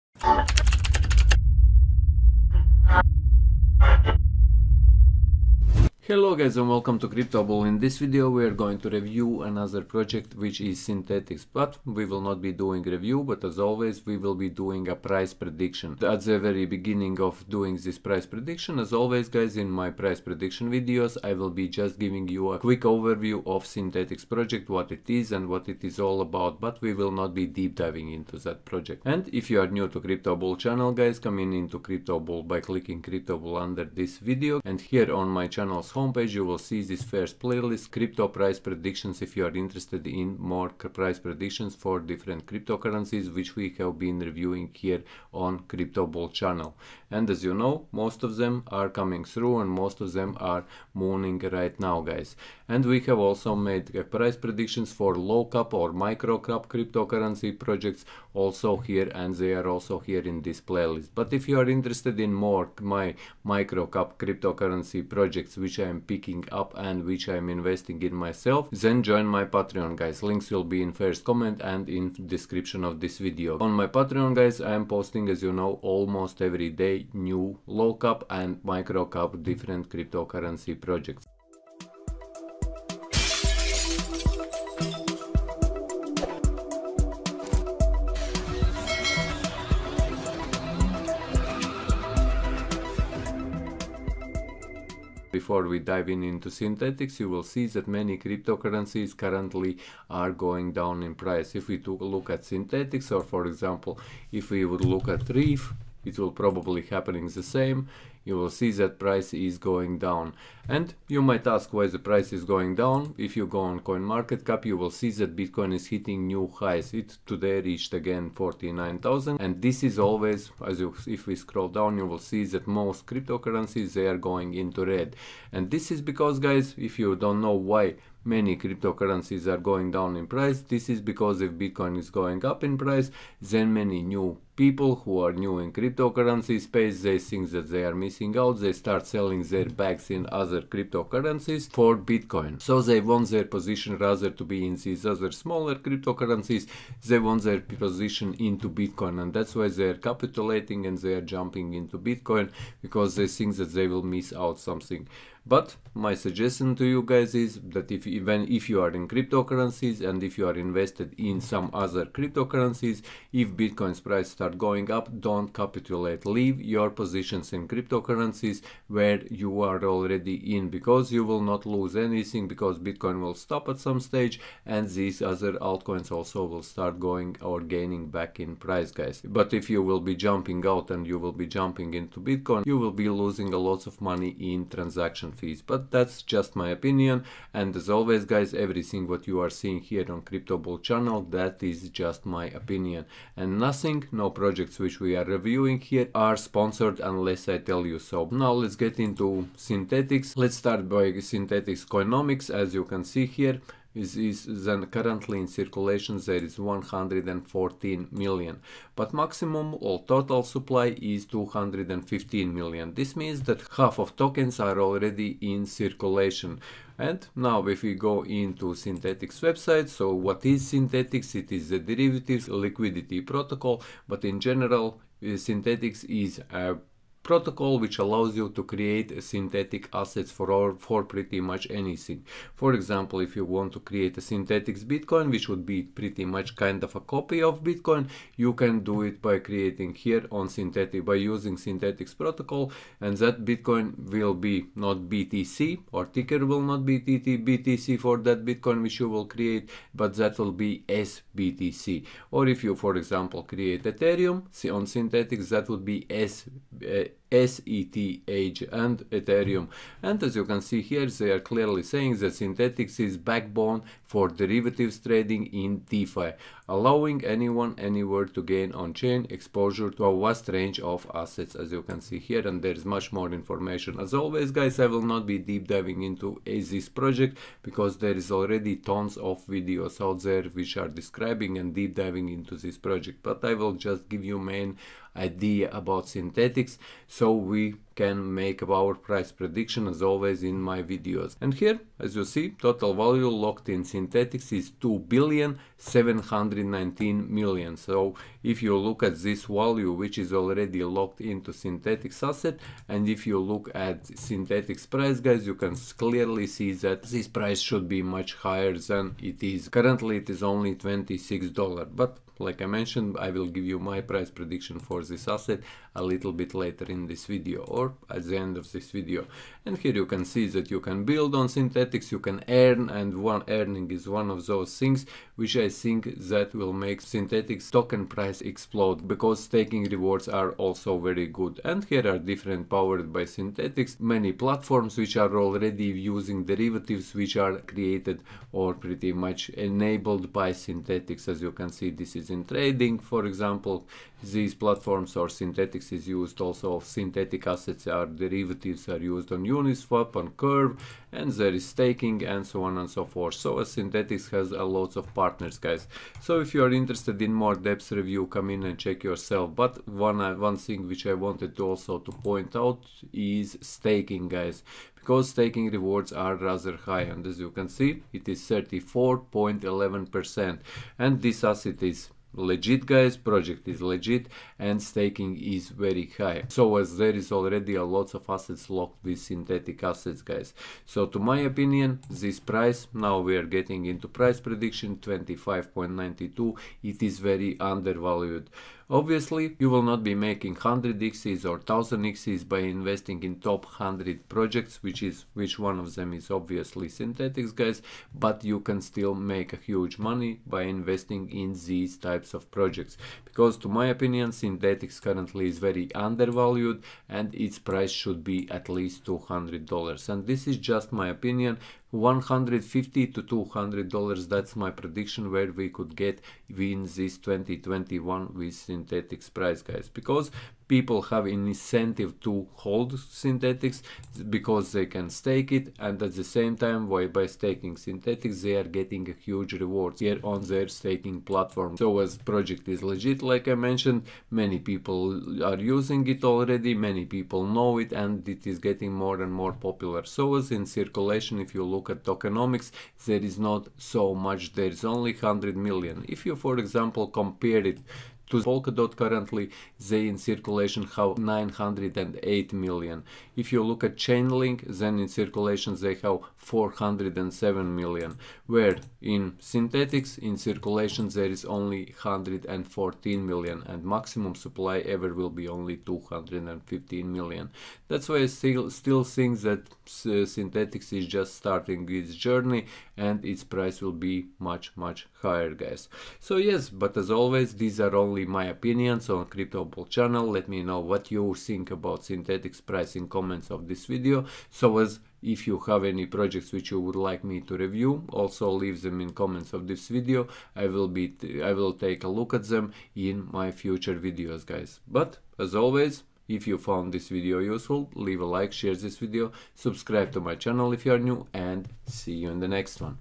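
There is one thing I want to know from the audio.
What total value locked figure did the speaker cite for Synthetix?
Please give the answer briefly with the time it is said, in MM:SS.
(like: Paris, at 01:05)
2 billion 719 million, at 04:54.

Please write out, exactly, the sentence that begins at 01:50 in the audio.
And you might ask why the price is going down.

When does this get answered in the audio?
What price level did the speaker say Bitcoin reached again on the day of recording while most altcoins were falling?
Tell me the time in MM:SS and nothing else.
01:58.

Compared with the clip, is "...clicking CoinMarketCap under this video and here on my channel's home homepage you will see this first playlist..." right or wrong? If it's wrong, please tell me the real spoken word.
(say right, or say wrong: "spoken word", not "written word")
wrong: "CryptoBull", not "CoinMarketCap".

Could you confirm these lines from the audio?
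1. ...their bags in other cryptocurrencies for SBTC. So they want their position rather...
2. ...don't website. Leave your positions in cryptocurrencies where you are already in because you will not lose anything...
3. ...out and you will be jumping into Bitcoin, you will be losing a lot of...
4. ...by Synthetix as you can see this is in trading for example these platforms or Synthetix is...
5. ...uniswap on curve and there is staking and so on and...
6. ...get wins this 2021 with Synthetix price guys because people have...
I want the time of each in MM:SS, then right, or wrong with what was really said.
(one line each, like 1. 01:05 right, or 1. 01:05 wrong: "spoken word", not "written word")
1. 02:19 wrong: "Bitcoin", not "SBTC"
2. 02:45 wrong: "capitulate", not "website"
3. 03:00 right
4. 05:40 right
5. 05:49 right
6. 06:55 right.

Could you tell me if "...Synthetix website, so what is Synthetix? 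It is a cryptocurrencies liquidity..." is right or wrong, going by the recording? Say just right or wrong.
wrong.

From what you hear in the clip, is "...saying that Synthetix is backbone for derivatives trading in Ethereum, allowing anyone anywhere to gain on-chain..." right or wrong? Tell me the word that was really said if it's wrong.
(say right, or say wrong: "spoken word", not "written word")
wrong: "DeFi", not "Ethereum".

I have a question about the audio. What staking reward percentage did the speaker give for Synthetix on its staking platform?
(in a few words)
34.11 percent.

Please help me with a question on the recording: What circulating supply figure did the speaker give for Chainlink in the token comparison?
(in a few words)
407 million.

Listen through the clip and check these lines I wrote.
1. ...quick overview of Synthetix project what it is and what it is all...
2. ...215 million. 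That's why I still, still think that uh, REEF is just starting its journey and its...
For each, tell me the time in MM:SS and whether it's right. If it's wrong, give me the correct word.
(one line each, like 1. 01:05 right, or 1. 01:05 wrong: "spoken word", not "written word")
1. 00:22 right
2. 07:45 wrong: "Synthetix", not "REEF".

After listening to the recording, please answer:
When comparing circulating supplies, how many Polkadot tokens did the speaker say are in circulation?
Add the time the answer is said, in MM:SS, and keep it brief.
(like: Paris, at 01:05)
908 million, at 07:31.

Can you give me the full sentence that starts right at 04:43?
But I will just give you main idea about Synthetix.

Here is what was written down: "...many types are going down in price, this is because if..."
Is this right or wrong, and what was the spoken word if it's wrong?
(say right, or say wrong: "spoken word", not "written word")
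wrong: "cryptocurrencies", not "types".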